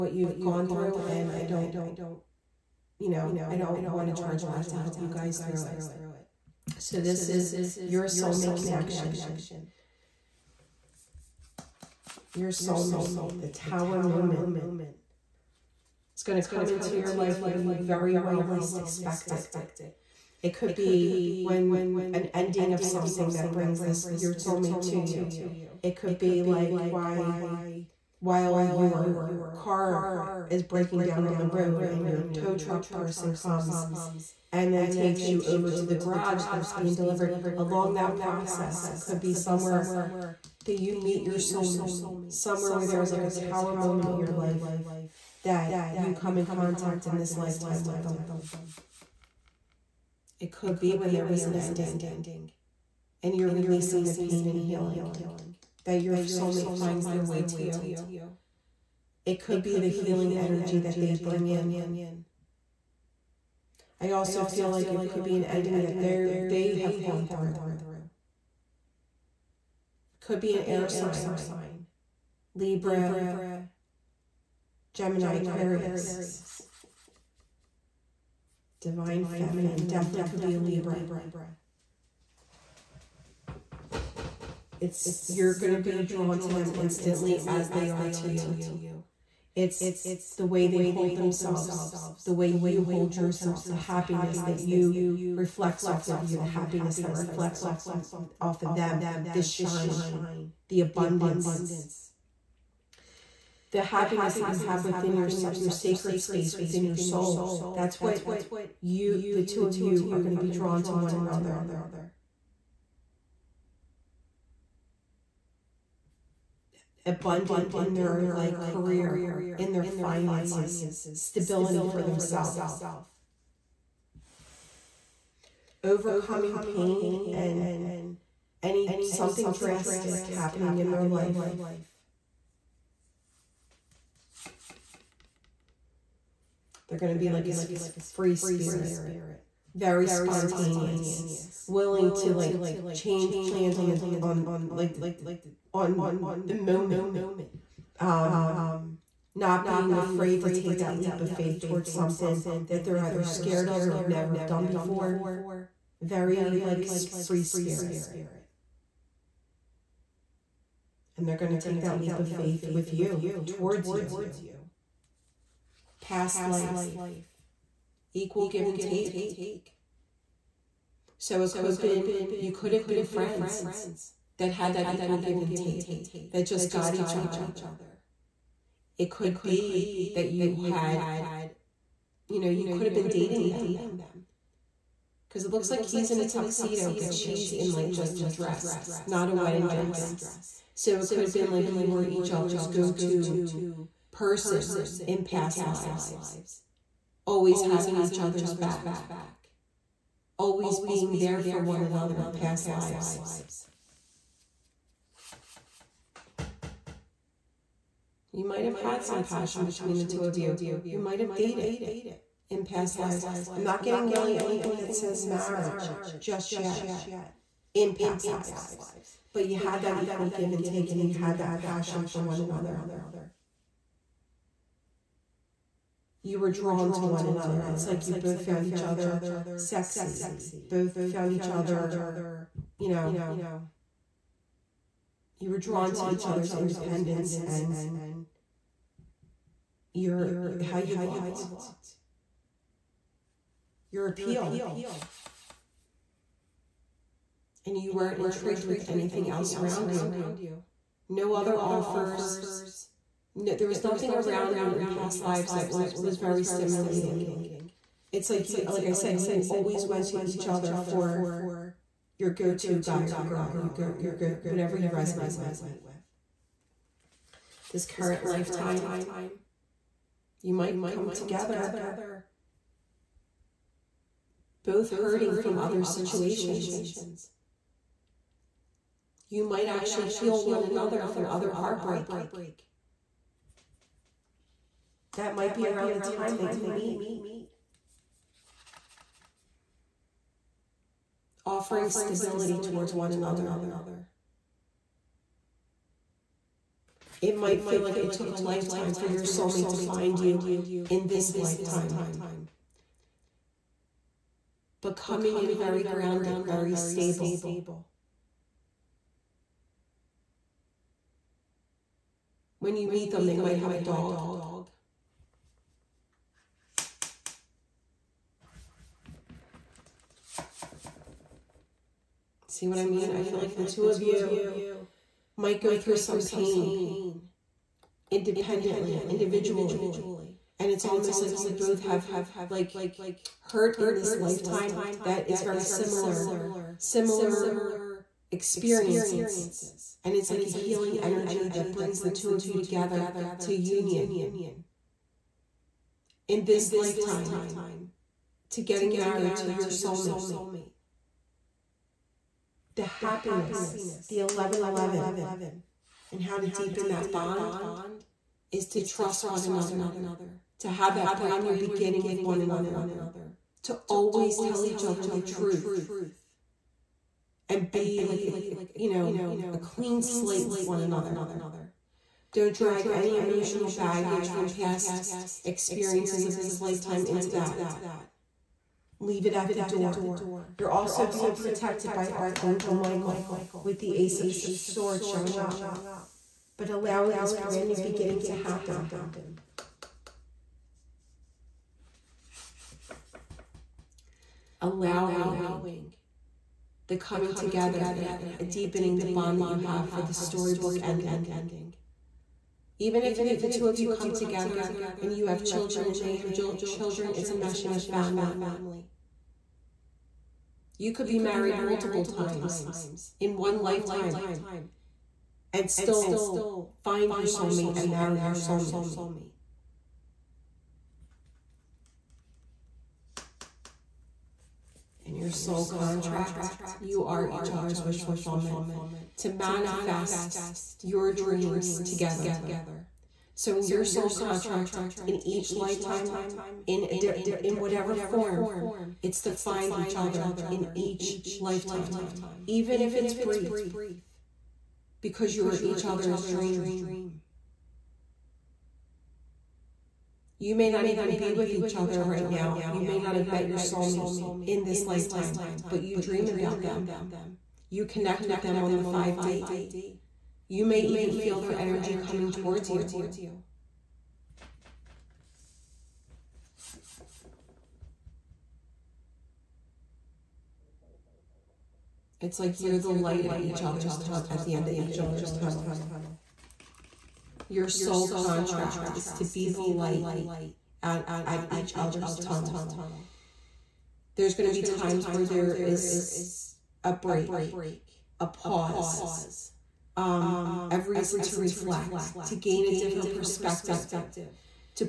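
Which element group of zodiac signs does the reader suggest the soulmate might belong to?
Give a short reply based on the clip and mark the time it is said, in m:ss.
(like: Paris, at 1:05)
air sign, at 1:10.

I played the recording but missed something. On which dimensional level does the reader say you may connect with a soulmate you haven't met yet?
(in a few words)
5D.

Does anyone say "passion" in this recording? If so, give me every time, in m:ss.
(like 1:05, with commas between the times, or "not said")
3:29, 3:41.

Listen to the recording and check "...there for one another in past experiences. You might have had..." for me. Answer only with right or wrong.
wrong.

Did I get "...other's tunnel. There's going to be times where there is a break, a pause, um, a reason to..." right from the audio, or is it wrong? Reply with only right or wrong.
right.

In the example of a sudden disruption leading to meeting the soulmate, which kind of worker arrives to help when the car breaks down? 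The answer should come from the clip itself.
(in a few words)
tow truck person.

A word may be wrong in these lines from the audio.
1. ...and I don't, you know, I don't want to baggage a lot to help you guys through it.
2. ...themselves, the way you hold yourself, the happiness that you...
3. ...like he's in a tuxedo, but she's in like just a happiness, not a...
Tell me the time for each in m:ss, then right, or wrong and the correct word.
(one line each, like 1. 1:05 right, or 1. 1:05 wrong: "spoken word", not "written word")
1. 0:01 wrong: "charge", not "baggage"
2. 1:31 right
3. 3:05 wrong: "dress", not "happiness".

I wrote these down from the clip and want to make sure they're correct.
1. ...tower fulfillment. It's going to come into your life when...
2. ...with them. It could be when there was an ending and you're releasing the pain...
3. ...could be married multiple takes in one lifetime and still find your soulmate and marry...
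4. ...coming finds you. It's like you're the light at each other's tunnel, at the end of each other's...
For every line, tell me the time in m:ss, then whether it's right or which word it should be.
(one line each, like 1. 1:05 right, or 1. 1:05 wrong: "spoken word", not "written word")
1. 0:13 wrong: "moment", not "fulfillment"
2. 0:47 right
3. 6:50 wrong: "times", not "takes"
4. 7:41 wrong: "towards", not "finds".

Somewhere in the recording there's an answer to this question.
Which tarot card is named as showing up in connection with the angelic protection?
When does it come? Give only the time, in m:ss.
6:23.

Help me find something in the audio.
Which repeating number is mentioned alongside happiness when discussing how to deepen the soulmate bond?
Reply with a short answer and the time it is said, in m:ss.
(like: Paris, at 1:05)
1111, at 5:54.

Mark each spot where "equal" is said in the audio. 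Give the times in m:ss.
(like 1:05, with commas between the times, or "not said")
2:48, 2:54, 3:40.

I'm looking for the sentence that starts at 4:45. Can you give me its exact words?
That might be around the time that you meet.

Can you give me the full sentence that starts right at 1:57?
abundant in their like career, in their finances, stability for themselves.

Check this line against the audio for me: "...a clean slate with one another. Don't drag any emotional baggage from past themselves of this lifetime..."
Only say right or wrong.
wrong.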